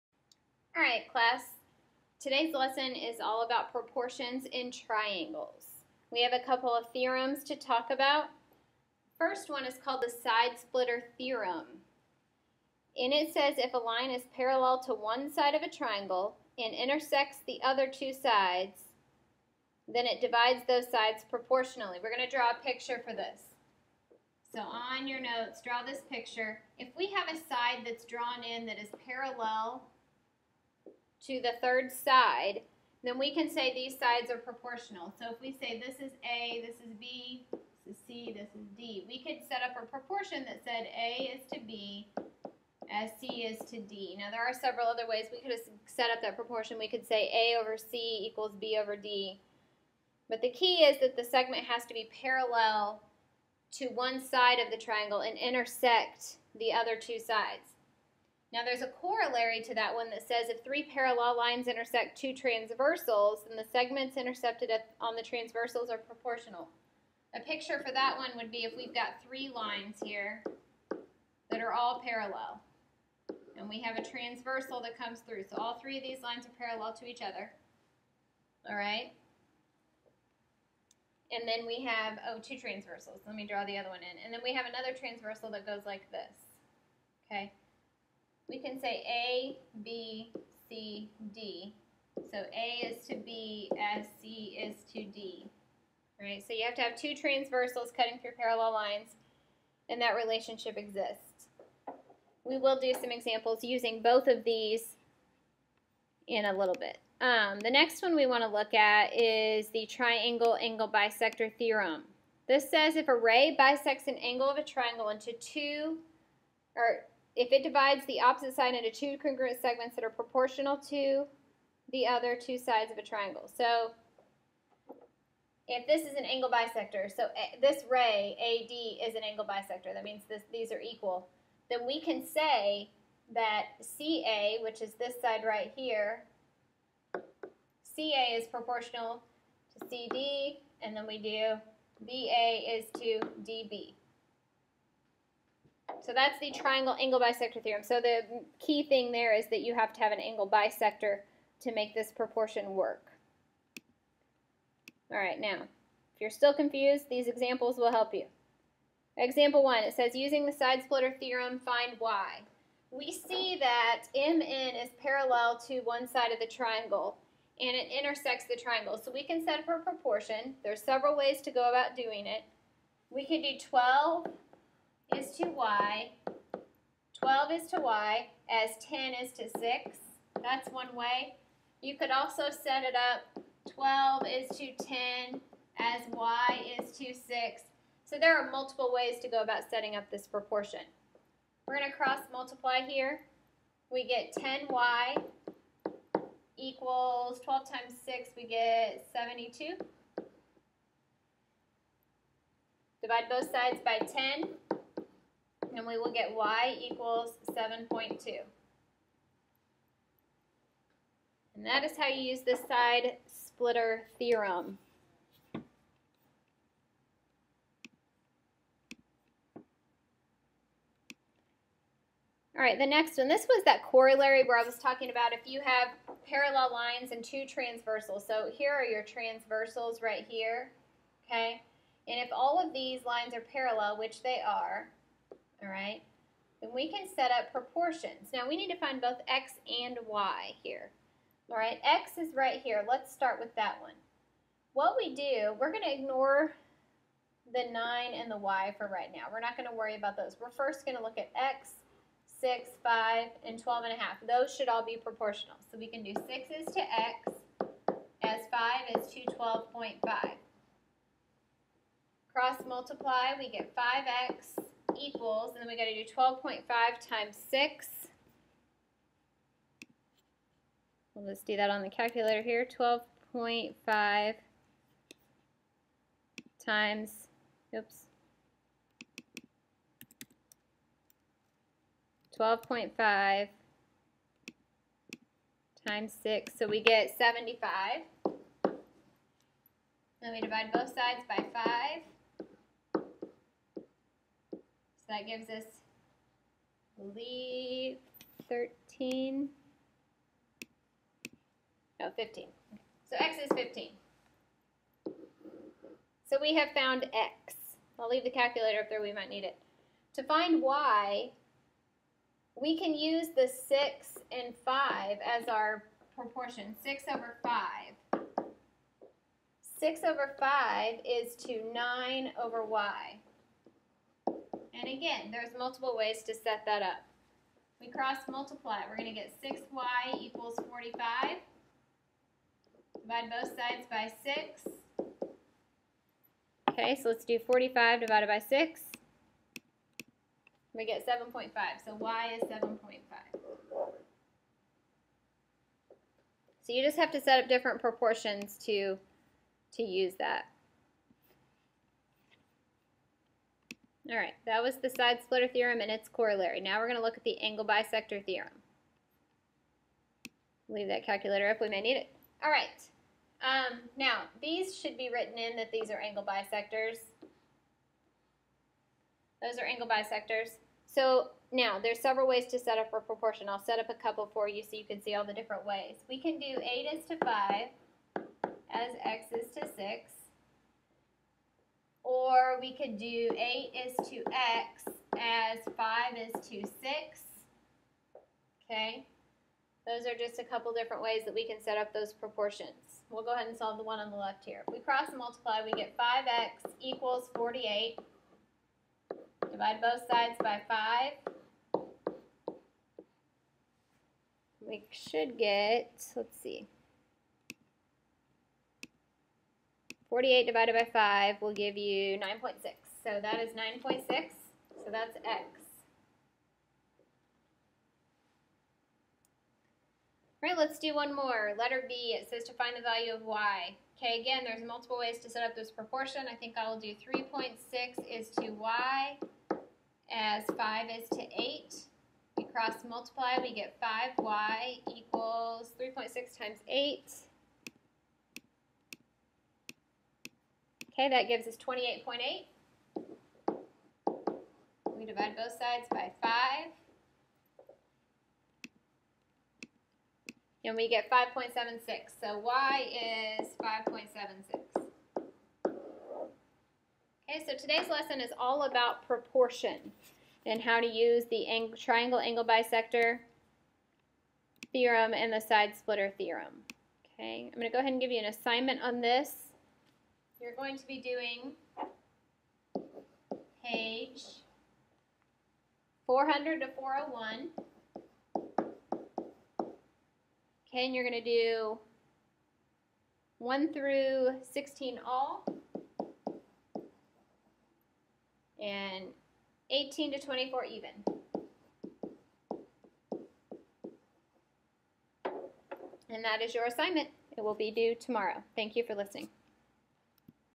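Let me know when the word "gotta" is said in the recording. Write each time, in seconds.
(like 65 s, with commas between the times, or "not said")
not said.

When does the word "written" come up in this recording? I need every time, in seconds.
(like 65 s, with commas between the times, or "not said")
365 s.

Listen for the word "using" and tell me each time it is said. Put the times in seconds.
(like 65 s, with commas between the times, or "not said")
103 s, 160 s.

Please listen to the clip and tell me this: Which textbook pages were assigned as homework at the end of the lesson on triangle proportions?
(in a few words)
400 to 401.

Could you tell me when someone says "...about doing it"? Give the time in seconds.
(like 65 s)
171 s.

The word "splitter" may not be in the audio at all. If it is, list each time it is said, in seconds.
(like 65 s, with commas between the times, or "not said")
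10 s, 160 s, 213 s, 355 s, 465 s.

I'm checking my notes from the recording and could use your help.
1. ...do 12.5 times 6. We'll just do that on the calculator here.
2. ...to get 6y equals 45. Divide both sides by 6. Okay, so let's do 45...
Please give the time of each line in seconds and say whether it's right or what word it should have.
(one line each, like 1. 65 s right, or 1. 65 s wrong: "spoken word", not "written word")
1. 265 s right
2. 329 s right.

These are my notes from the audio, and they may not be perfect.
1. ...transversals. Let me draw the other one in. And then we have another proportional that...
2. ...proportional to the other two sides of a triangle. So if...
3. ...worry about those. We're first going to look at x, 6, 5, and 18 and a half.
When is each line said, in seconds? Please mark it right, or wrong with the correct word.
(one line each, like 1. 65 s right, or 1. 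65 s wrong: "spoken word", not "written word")
1. 82 s wrong: "transversal", not "proportional"
2. 120 s right
3. 249 s wrong: "12", not "18".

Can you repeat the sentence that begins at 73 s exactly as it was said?
And we have a transversal that comes through.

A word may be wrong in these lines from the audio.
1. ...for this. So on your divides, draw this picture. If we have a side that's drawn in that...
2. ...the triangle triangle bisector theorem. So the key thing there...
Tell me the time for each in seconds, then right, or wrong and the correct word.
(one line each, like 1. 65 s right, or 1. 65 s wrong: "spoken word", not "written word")
1. 23 s wrong: "notes", not "divides"
2. 146 s wrong: "angle", not "triangle".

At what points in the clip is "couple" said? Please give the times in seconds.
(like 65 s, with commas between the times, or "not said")
6 s, 373 s, 390 s.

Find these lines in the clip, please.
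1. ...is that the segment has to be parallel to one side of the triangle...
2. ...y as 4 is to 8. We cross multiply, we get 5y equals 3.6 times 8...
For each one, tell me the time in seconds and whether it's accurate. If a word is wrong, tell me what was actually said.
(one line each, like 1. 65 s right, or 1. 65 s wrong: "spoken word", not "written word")
1. 50 s right
2. 428 s wrong: "5", not "4".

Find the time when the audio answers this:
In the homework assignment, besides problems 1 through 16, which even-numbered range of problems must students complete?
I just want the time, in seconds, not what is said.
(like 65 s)
489 s.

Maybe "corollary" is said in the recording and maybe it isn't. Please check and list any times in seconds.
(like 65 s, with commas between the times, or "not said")
58 s, 223 s, 356 s.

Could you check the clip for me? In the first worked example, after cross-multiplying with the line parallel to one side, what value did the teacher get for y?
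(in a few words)
7.2.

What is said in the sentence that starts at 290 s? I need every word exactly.
Then we divide both sides by 5.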